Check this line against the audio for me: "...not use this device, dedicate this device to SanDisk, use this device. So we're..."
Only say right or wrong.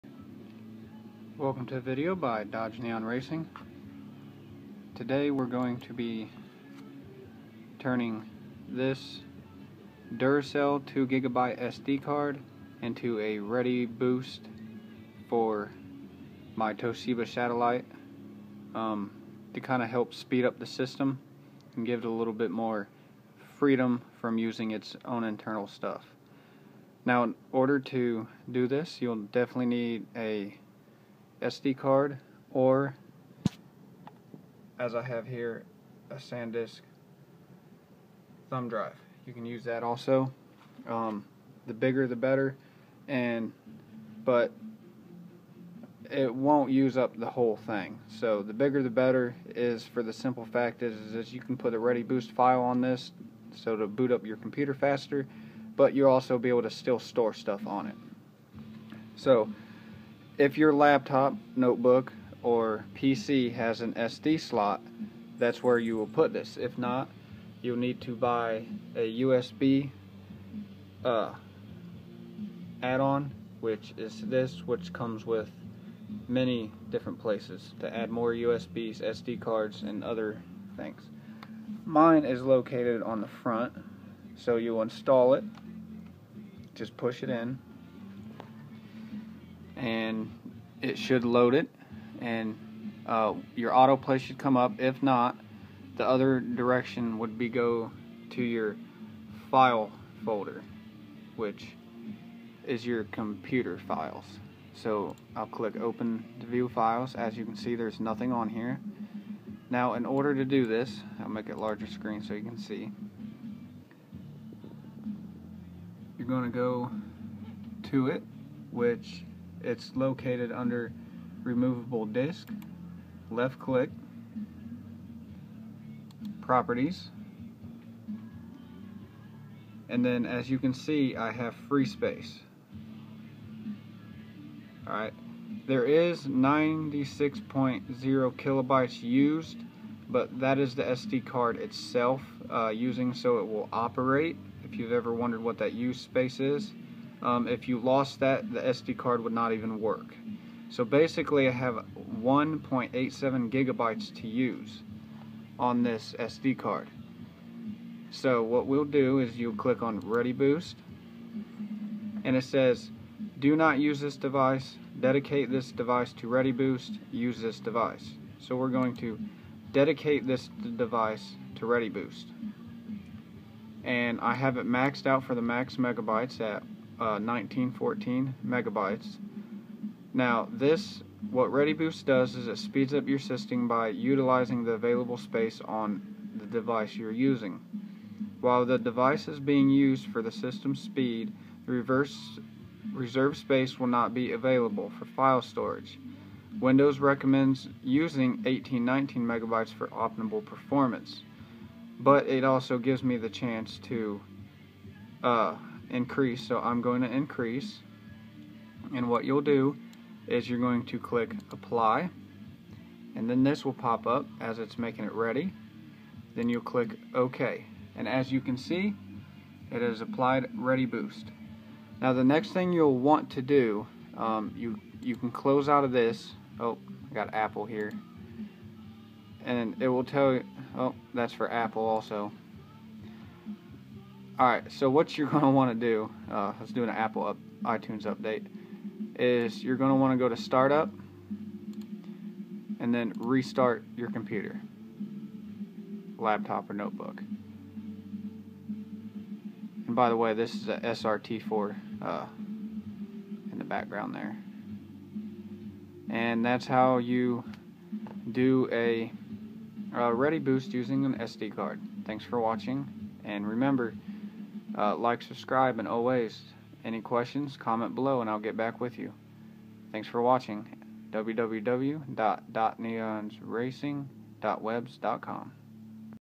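wrong.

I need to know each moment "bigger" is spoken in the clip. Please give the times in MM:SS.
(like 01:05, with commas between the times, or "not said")
00:41, 00:48.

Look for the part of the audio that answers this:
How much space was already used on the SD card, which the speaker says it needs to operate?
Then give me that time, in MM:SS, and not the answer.
02:16.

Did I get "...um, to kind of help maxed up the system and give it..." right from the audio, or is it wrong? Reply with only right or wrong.
wrong.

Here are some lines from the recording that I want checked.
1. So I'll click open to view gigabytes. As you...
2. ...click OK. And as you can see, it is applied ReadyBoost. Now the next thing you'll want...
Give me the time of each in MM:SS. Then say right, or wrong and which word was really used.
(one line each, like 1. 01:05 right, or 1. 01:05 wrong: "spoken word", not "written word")
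1. 01:44 wrong: "files", not "gigabytes"
2. 03:36 right.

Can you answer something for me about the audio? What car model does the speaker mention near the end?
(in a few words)
SRT4.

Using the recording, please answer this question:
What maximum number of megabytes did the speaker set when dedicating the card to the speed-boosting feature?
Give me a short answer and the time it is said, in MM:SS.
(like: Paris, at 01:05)
1914, at 02:57.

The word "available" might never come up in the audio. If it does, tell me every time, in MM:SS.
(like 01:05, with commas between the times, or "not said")
03:04, 03:14.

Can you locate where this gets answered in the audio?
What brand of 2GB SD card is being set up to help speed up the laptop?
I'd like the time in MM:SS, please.
00:10.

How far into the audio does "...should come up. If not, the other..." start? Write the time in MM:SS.
01:34.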